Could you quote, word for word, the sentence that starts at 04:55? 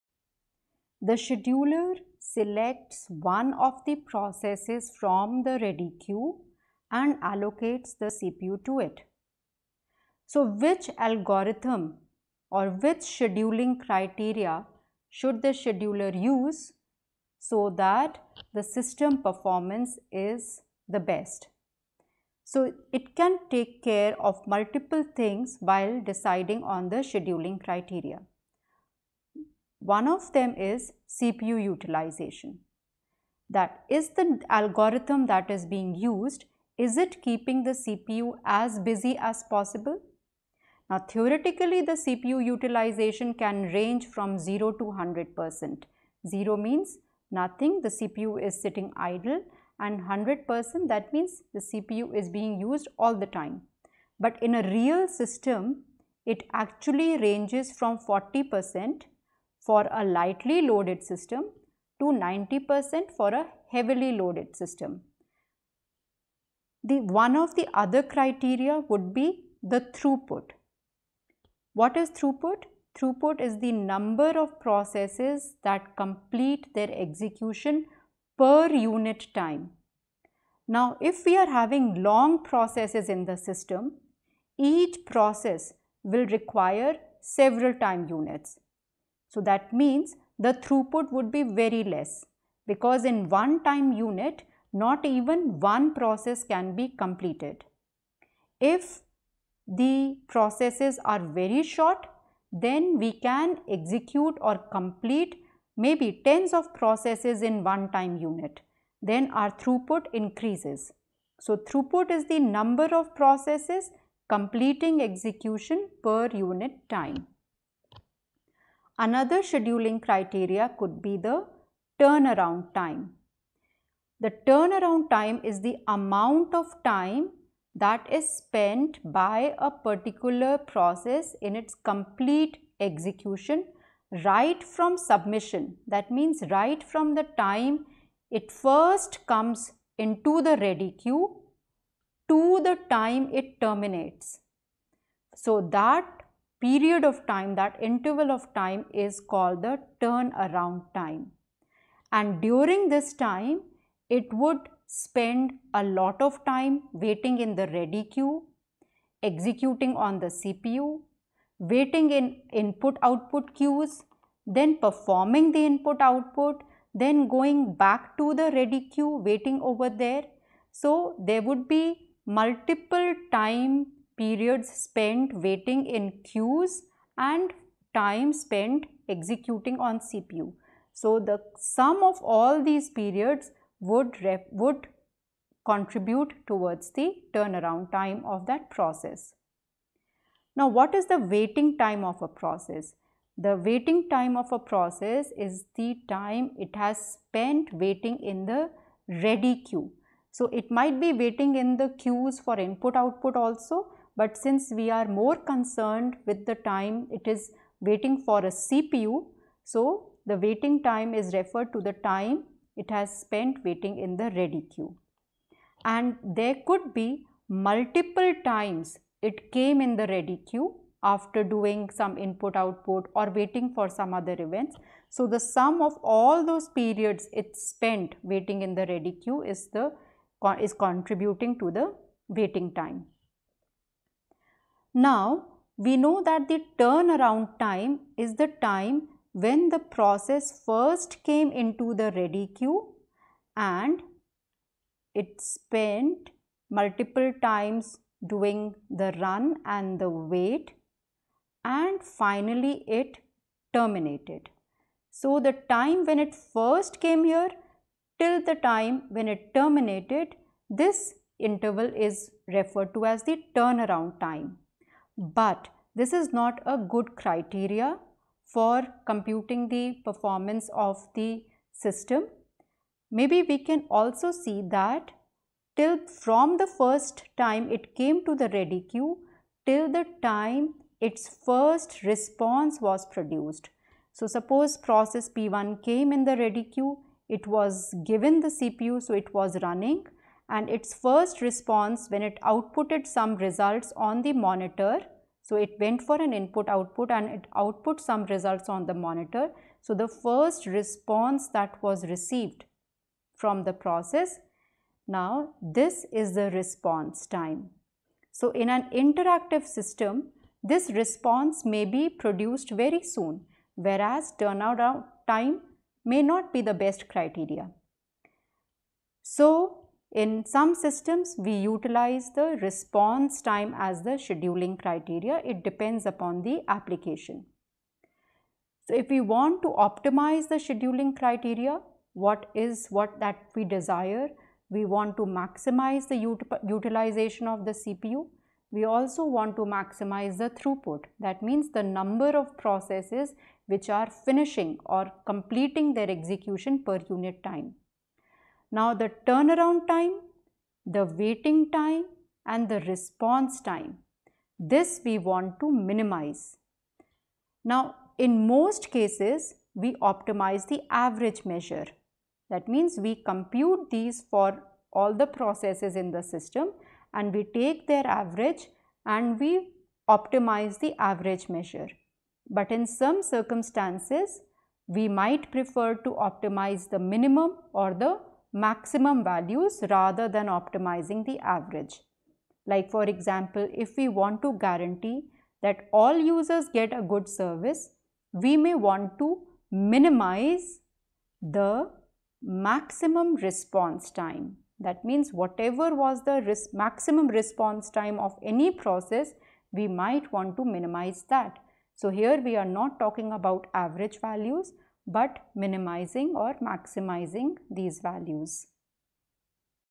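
So, it went for an input output and it output some results on the monitor.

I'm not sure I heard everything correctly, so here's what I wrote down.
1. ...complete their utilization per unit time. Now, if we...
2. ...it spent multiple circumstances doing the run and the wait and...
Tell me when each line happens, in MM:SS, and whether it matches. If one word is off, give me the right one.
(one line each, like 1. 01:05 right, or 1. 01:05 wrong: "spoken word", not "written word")
1. 01:15 wrong: "execution", not "utilization"
2. 04:05 wrong: "times", not "circumstances".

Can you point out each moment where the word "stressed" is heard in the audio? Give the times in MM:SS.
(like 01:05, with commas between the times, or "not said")
not said.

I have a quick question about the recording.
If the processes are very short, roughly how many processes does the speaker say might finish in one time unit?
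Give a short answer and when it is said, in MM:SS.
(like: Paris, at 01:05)
tens of processes, at 01:46.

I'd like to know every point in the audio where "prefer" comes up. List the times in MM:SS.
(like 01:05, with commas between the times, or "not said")
06:15.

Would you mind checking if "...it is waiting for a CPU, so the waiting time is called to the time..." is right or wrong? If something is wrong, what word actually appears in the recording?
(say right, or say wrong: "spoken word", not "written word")
wrong: "referred", not "called".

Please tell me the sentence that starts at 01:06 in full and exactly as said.
The one of the other criteria would be the throughput.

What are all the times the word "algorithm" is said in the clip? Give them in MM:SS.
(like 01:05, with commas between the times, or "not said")
00:10, 00:34.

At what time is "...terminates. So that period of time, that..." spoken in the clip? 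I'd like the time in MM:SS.
02:23.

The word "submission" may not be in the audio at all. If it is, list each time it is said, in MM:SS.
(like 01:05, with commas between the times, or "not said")
02:14.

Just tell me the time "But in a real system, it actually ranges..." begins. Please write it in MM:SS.
00:54.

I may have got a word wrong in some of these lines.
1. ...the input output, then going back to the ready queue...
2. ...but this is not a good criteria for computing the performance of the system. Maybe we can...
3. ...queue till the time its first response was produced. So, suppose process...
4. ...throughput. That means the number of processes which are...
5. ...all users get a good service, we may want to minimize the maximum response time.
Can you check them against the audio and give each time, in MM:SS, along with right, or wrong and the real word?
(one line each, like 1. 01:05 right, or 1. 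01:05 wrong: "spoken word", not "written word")
1. 02:45 right
2. 04:25 right
3. 04:38 right
4. 05:40 right
5. 06:25 right.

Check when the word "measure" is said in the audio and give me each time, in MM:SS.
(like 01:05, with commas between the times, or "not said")
06:01, 06:11.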